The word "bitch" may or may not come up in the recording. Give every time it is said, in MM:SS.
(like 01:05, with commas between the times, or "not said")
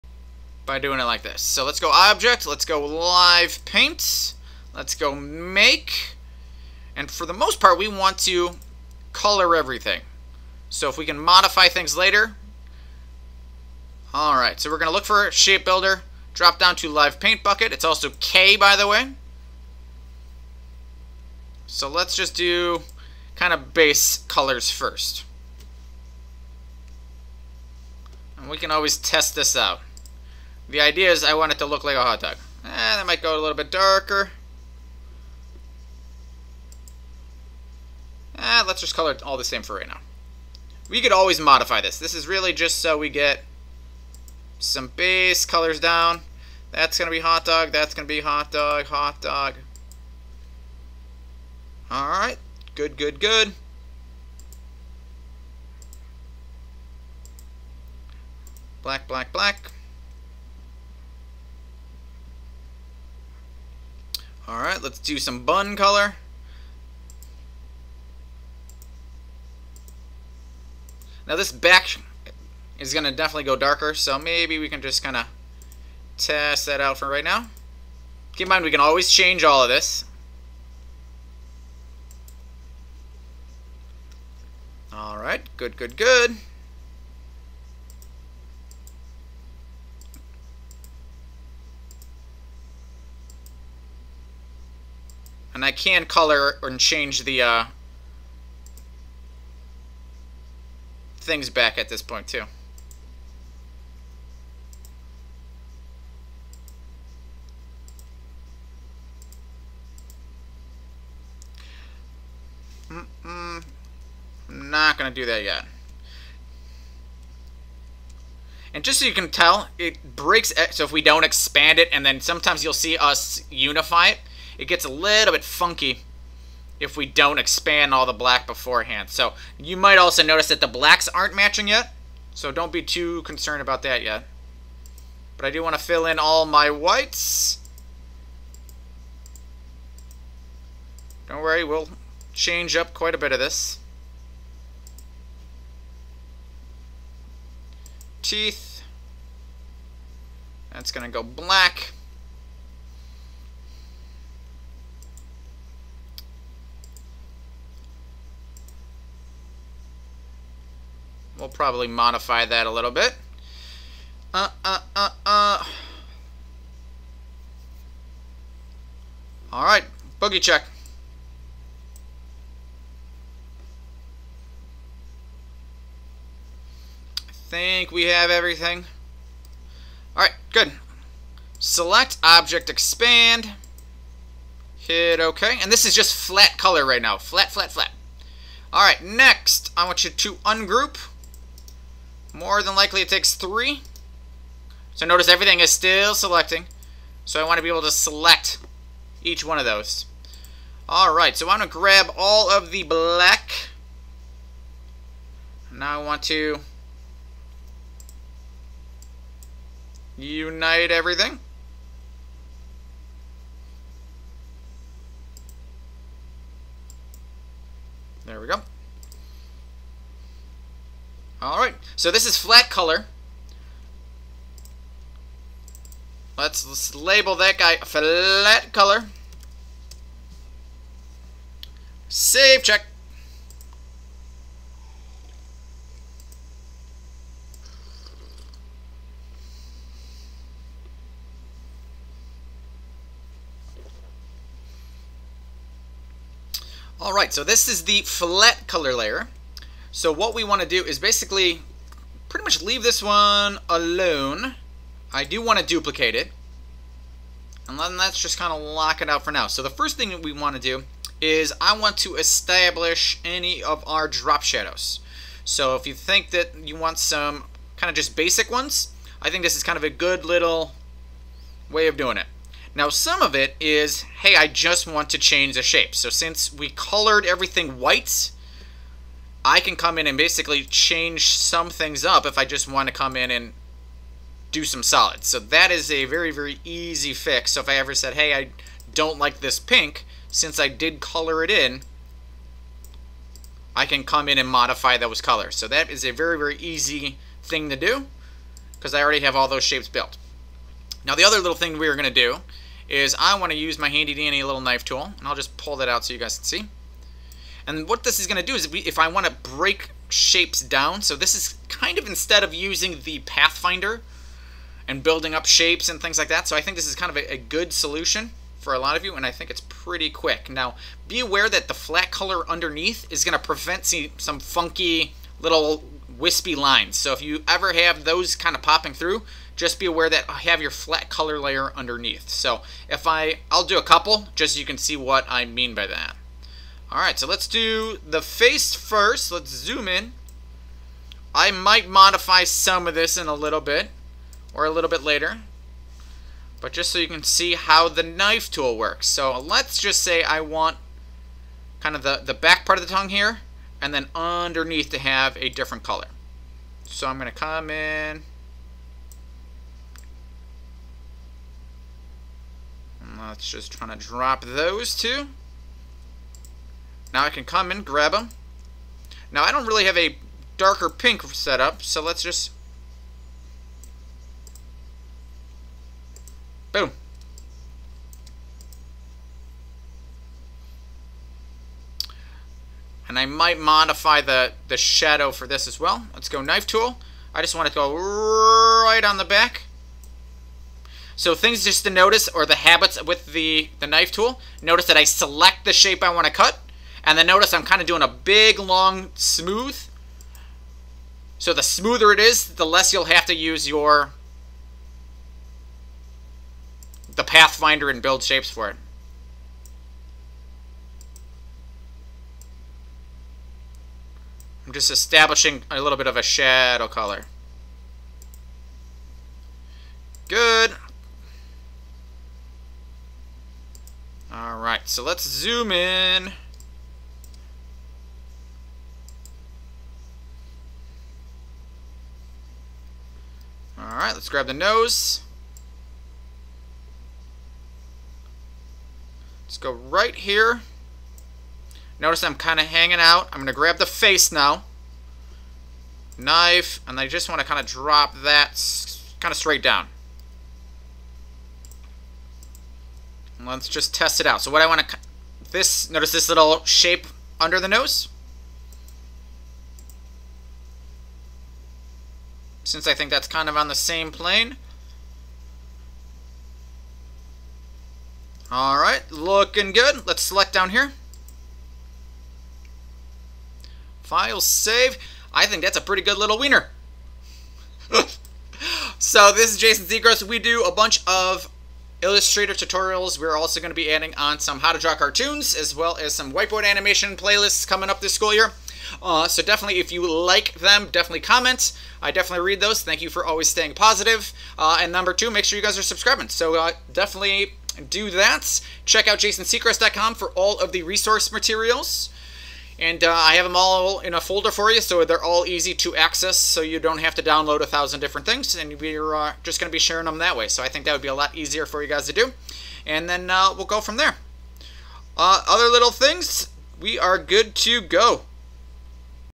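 not said.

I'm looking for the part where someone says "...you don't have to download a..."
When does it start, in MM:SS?
08:26.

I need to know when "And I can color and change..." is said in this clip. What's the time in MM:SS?
01:35.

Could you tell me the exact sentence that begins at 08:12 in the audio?
Thank you for always staying positive.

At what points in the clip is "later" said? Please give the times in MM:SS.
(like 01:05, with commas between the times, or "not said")
00:11, 05:45.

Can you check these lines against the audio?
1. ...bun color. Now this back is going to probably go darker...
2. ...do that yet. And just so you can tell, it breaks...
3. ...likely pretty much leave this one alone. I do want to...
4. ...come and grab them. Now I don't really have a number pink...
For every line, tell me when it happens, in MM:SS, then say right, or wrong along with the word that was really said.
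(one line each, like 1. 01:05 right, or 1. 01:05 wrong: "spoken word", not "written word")
1. 01:05 wrong: "definitely", not "probably"
2. 01:55 right
3. 04:10 wrong: "basically", not "likely"
4. 06:07 wrong: "darker", not "number".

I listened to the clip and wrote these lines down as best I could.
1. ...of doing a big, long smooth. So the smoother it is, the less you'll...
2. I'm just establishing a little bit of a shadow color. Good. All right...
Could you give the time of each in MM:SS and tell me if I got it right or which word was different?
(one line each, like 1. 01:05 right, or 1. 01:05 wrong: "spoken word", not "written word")
1. 06:37 right
2. 06:54 right.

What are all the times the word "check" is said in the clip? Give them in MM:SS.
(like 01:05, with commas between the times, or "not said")
02:50, 03:52, 08:18.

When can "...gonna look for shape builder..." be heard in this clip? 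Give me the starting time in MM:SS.
00:14.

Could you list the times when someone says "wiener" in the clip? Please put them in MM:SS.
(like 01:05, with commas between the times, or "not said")
07:56.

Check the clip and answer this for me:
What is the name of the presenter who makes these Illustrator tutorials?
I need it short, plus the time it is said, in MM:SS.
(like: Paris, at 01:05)
Jason Secrest, at 07:59.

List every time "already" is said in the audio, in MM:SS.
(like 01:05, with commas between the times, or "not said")
04:59.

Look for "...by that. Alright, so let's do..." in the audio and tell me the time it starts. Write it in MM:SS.
05:35.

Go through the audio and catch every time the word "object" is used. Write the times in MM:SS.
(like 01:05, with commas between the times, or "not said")
00:01, 03:02.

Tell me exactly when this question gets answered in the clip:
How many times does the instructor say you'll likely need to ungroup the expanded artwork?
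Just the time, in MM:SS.
03:13.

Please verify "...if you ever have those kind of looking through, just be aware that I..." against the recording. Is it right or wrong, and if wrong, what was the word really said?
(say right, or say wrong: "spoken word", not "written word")
wrong: "popping", not "looking".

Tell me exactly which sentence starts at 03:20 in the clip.
Alright, so I'm going to grab all of the black.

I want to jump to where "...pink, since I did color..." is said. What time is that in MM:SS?
04:49.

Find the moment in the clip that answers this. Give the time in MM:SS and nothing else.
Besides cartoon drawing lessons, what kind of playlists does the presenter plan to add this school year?
08:06.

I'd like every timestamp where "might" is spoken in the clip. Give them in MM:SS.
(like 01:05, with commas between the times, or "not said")
00:33, 02:09, 05:41, 06:23.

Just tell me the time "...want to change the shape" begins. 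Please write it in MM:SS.
04:34.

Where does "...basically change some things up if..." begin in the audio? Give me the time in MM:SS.
04:40.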